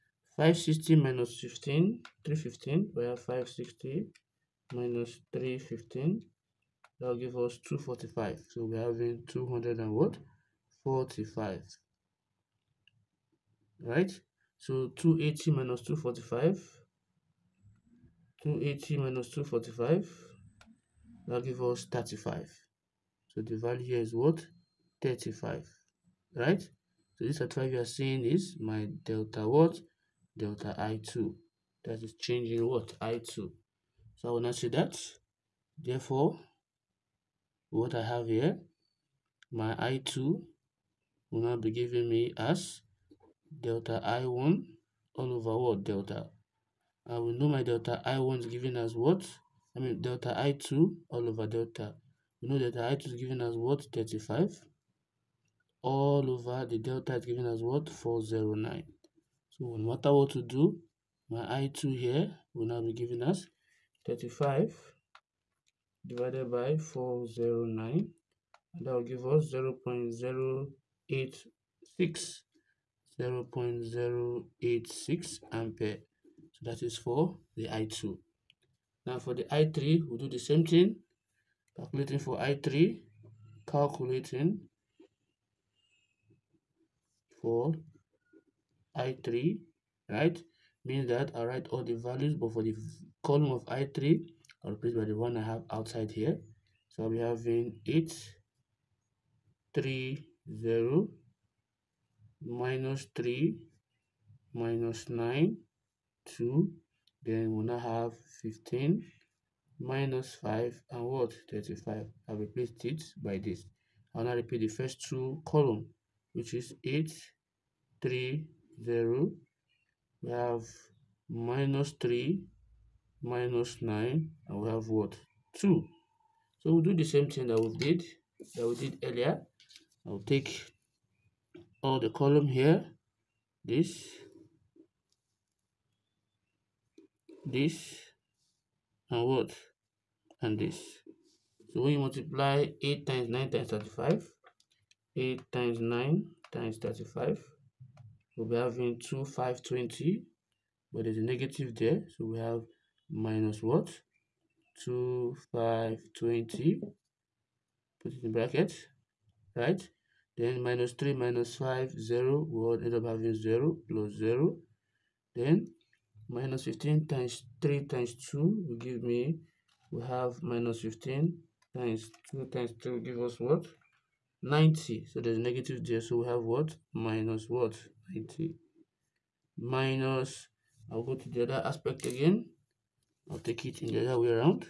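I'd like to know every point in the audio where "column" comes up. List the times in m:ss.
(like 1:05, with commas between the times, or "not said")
1:33, 1:55, 2:12.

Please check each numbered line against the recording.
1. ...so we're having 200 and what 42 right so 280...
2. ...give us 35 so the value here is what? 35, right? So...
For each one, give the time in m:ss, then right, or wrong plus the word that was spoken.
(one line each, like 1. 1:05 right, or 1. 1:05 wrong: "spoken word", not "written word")
1. 0:08 wrong: "45", not "42"
2. 0:21 right.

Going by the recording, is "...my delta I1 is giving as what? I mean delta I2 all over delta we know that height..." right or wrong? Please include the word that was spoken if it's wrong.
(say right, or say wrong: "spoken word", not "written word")
right.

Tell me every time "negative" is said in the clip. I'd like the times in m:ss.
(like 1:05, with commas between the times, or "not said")
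2:31, 2:55.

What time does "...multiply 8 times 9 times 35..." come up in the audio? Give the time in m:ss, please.
2:21.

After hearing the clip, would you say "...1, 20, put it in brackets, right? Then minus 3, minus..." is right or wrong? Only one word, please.
wrong.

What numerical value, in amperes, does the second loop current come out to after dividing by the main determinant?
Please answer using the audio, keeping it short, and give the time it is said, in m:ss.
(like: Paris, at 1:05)
0.086, at 1:13.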